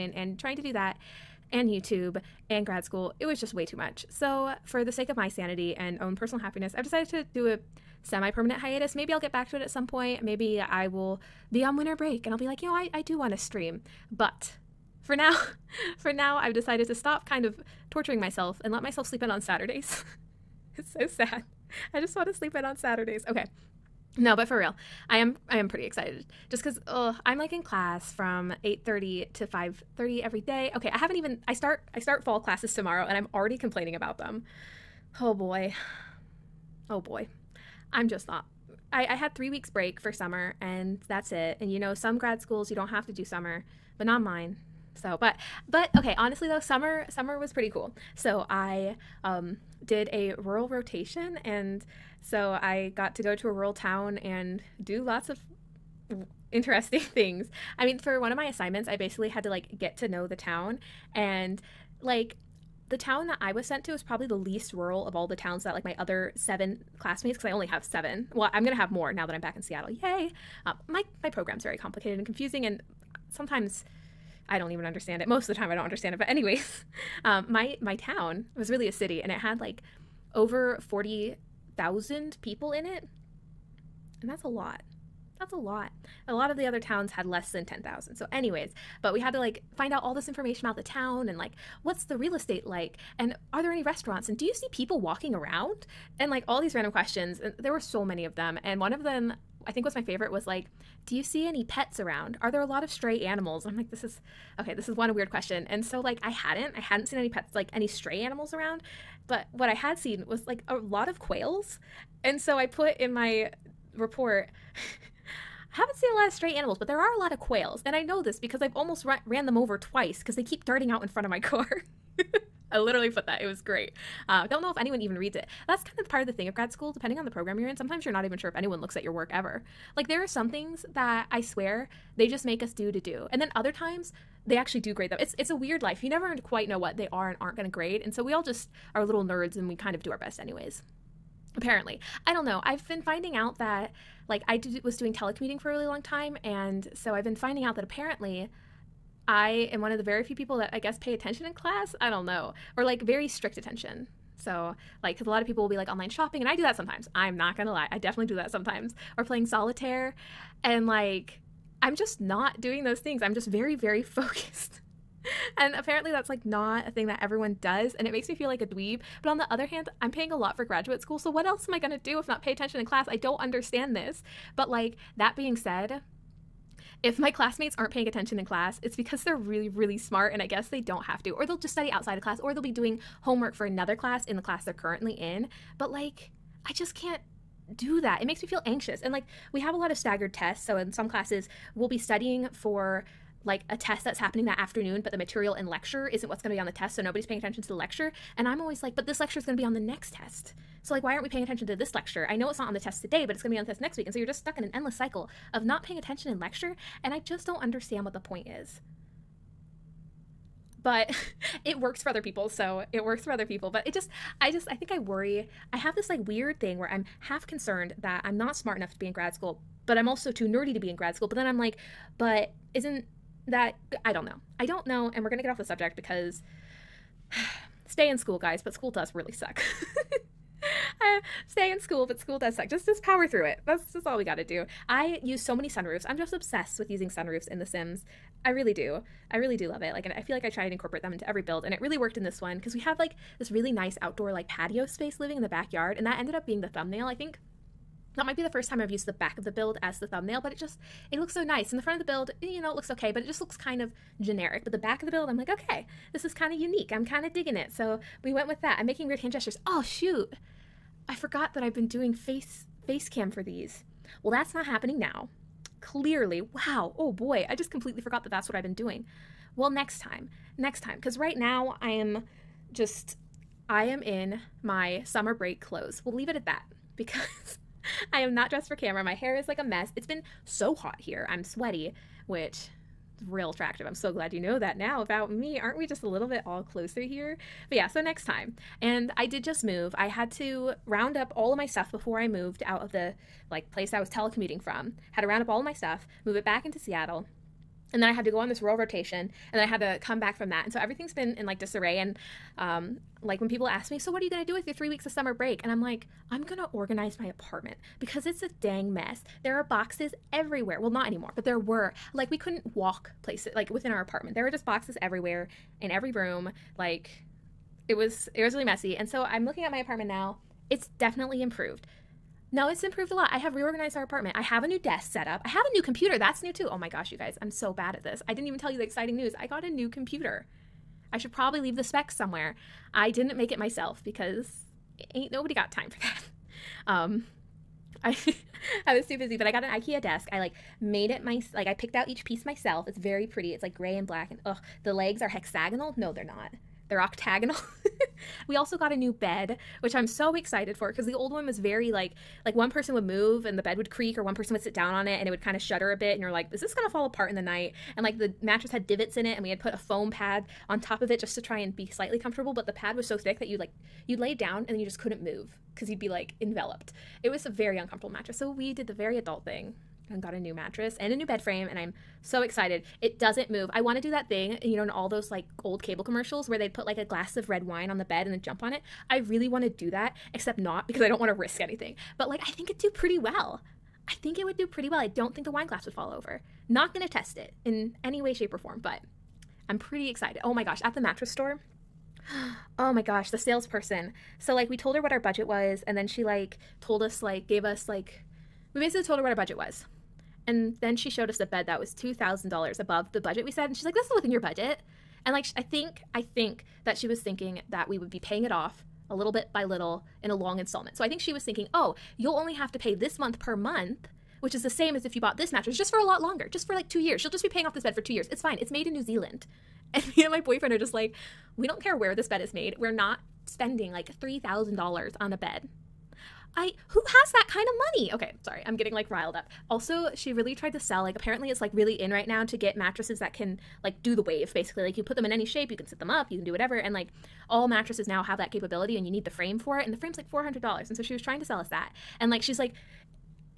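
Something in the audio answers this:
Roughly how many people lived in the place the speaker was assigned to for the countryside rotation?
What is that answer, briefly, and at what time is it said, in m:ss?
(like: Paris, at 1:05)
40,000, at 1:20.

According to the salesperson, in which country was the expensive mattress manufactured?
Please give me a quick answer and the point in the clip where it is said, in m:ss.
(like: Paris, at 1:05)
New Zealand, at 6:58.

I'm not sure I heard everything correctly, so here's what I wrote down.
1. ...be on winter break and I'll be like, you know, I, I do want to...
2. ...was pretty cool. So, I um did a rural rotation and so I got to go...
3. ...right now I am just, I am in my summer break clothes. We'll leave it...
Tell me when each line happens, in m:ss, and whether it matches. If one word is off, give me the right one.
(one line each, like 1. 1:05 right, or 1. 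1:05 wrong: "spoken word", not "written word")
1. 0:11 right
2. 0:47 right
3. 4:31 right.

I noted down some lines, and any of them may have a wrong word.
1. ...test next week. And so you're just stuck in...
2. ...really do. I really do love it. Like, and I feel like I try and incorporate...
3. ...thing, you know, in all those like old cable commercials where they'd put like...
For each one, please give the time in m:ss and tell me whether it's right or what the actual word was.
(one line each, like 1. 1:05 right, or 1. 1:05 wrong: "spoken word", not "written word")
1. 3:23 right
2. 3:58 right
3. 6:14 right.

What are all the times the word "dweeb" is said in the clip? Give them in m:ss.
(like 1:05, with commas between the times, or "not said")
2:48.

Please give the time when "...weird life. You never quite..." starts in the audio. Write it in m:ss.
2:15.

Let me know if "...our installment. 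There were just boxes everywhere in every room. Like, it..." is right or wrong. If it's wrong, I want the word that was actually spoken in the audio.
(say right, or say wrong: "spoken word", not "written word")
wrong: "apartment", not "installment".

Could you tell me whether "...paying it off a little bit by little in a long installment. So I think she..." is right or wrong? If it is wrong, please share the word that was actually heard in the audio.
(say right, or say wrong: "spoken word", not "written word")
right.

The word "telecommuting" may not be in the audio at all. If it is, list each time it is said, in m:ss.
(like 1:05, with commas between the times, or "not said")
2:25, 4:54.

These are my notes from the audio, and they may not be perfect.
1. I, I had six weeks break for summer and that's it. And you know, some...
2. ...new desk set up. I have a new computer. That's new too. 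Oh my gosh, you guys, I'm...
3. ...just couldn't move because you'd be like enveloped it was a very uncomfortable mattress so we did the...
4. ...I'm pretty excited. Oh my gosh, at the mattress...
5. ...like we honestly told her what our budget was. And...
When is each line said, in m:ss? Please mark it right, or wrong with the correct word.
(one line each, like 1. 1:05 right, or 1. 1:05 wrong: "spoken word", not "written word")
1. 0:38 wrong: "three", not "six"
2. 5:24 right
3. 6:04 right
4. 6:29 right
5. 6:37 wrong: "basically", not "honestly".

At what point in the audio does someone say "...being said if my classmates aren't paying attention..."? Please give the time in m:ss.
2:55.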